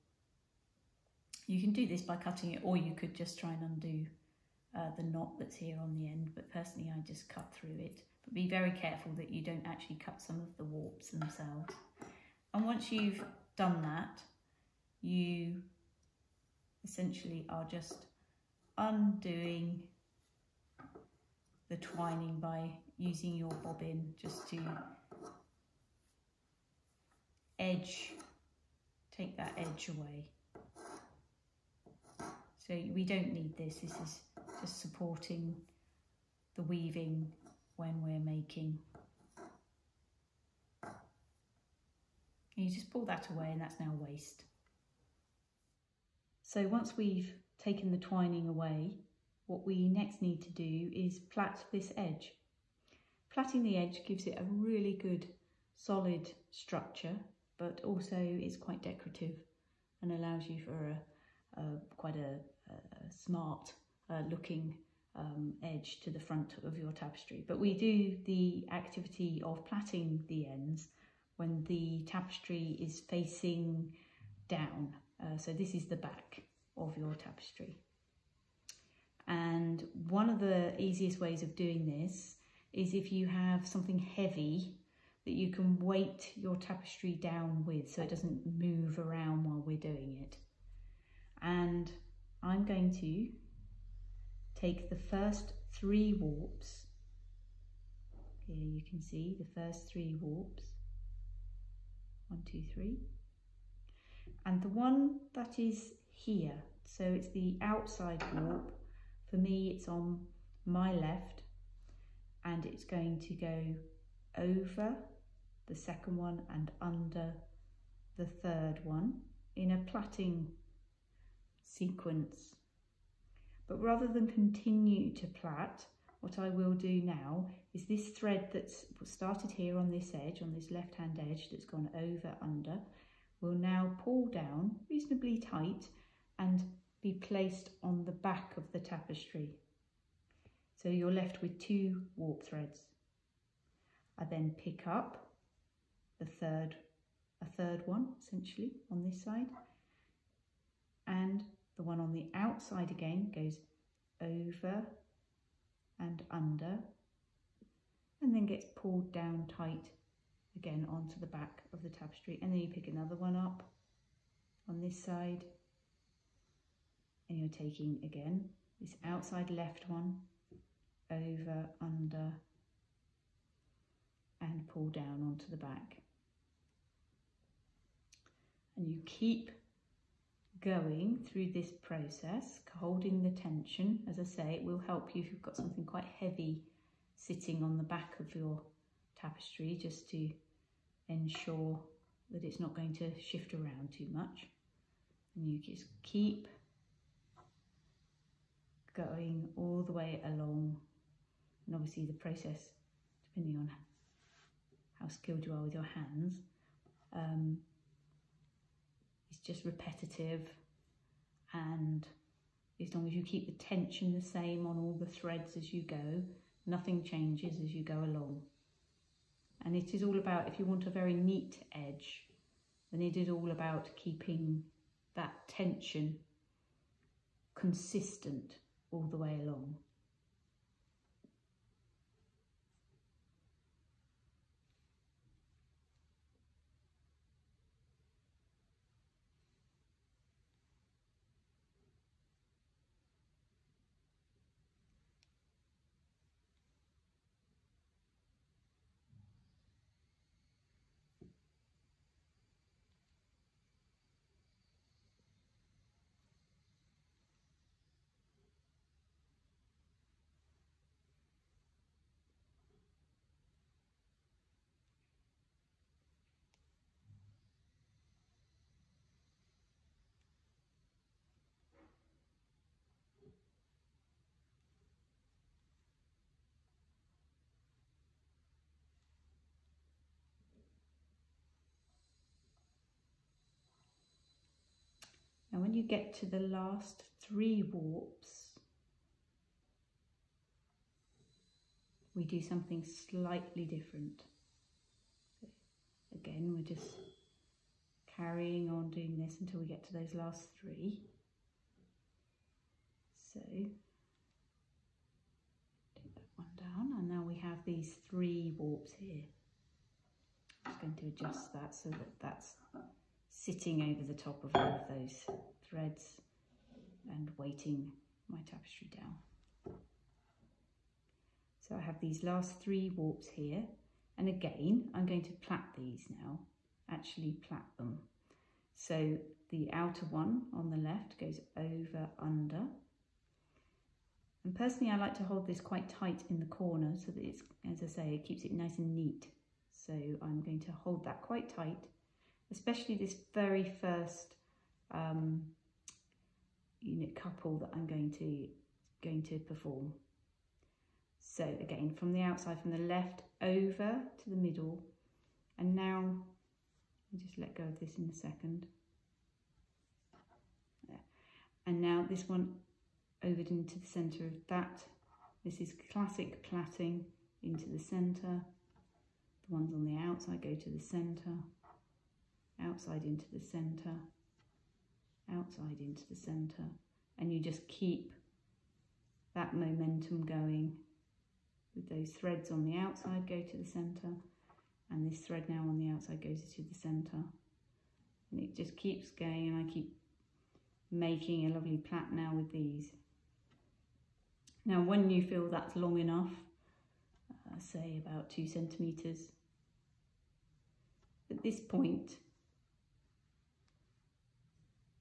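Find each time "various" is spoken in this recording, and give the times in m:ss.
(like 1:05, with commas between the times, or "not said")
not said.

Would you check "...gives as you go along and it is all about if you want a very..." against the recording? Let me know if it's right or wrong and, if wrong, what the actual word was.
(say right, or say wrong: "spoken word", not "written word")
wrong: "changes", not "gives".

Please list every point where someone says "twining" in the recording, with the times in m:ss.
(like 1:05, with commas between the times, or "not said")
0:21, 0:47.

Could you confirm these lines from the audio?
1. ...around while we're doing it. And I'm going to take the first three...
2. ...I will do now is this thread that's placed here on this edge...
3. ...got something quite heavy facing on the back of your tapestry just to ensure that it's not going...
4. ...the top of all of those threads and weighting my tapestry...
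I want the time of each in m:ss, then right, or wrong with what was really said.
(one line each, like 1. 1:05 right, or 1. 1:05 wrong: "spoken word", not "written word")
1. 1:28 right
2. 2:06 wrong: "started", not "placed"
3. 3:05 wrong: "sitting", not "facing"
4. 5:14 right.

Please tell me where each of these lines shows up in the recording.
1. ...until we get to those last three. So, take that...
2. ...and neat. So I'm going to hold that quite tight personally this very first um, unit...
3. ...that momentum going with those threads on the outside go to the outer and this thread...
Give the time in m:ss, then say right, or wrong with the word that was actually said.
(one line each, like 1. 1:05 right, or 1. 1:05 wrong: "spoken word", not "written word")
1. 4:59 right
2. 5:38 wrong: "especially", not "personally"
3. 6:19 wrong: "center", not "outer".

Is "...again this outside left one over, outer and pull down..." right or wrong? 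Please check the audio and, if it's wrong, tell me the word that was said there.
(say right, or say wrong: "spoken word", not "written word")
wrong: "under", not "outer".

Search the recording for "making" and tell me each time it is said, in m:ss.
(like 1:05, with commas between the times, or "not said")
0:38, 6:30.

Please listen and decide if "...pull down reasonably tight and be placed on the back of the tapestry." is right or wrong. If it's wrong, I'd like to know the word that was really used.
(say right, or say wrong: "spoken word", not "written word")
right.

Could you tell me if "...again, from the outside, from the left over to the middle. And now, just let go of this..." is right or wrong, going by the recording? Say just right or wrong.
right.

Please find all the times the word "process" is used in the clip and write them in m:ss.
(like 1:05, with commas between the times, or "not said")
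3:01, 3:22.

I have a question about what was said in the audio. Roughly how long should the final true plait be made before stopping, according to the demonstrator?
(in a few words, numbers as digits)
2 centimeters.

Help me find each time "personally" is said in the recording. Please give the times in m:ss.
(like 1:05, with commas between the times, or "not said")
0:06, 5:34.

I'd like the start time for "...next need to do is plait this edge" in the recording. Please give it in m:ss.
0:49.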